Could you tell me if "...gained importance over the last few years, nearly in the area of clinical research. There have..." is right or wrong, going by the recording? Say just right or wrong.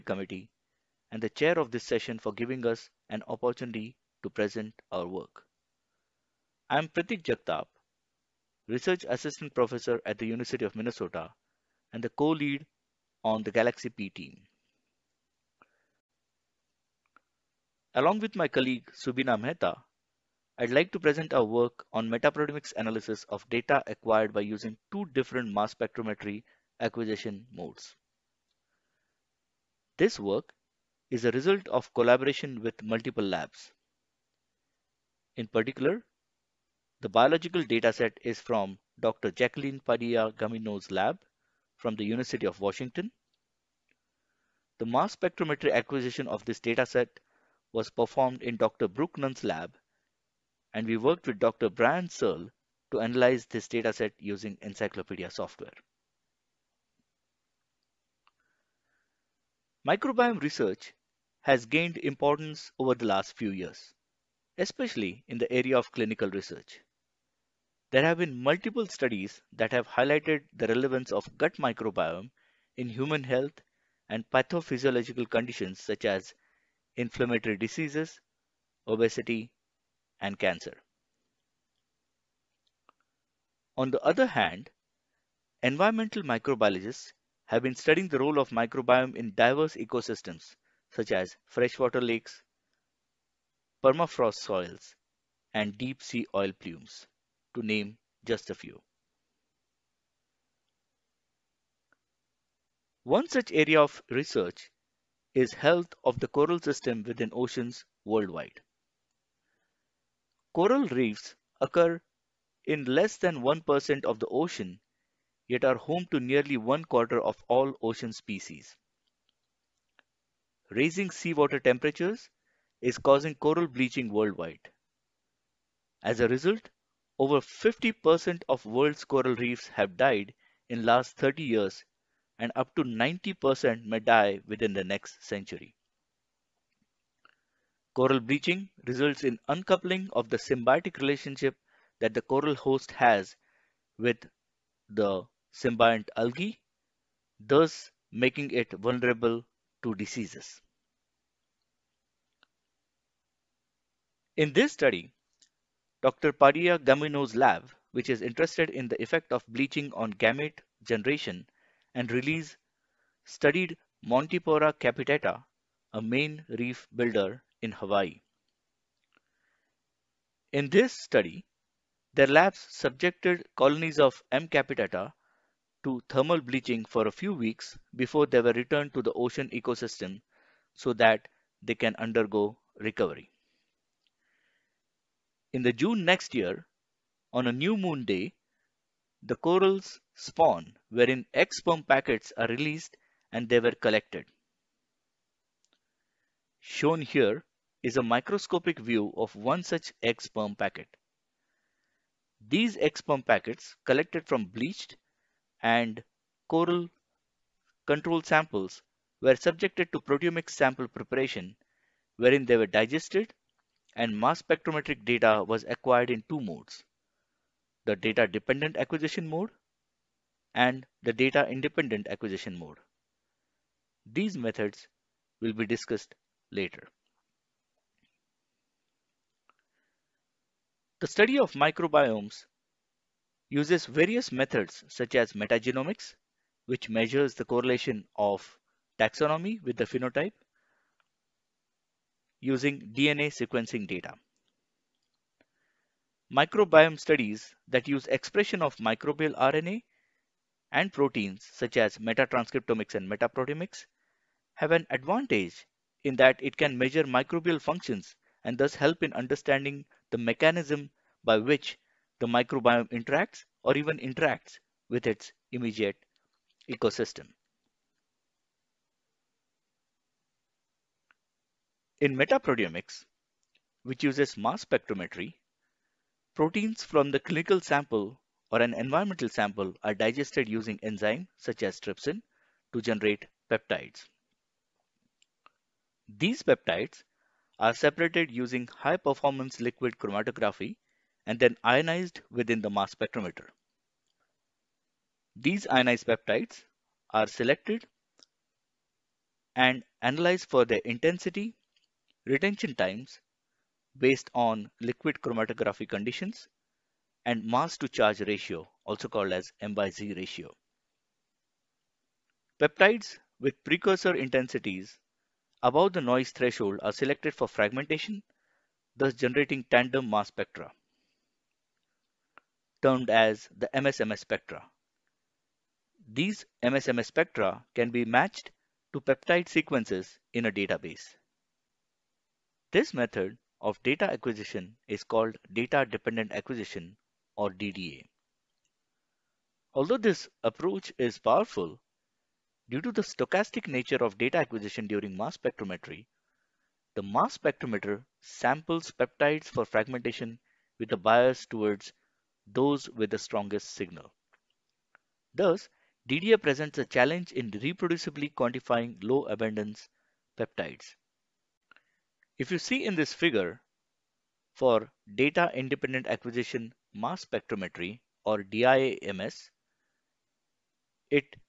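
wrong.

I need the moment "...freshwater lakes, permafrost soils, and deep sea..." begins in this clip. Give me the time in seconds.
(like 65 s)
91 s.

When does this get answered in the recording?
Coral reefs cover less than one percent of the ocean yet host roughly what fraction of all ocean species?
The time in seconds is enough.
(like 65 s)
116 s.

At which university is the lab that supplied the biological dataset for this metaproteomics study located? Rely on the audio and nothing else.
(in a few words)
University of Washington.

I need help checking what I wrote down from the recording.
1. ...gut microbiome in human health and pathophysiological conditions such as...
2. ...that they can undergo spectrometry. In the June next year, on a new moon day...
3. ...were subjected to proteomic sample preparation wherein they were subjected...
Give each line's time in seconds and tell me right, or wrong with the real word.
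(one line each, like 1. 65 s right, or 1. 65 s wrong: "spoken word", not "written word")
1. 71 s right
2. 180 s wrong: "recovery", not "spectrometry"
3. 209 s wrong: "digested", not "subjected".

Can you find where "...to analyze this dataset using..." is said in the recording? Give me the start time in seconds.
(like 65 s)
52 s.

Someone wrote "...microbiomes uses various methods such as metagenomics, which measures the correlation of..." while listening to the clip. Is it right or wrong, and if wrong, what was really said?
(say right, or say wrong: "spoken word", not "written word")
right.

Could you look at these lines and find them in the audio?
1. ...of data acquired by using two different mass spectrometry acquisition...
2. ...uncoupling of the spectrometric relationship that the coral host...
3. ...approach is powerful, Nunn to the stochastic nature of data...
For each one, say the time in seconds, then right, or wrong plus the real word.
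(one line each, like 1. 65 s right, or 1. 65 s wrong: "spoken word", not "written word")
1. 23 s right
2. 139 s wrong: "symbiotic", not "spectrometric"
3. 340 s wrong: "Due", not "Nunn".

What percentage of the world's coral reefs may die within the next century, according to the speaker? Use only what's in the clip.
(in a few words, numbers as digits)
up to 90%.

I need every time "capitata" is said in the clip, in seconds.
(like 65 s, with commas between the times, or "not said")
164 s, 174 s.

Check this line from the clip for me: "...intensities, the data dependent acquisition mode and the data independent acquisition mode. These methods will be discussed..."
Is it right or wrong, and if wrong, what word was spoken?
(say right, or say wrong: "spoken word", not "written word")
wrong: "modes", not "intensities".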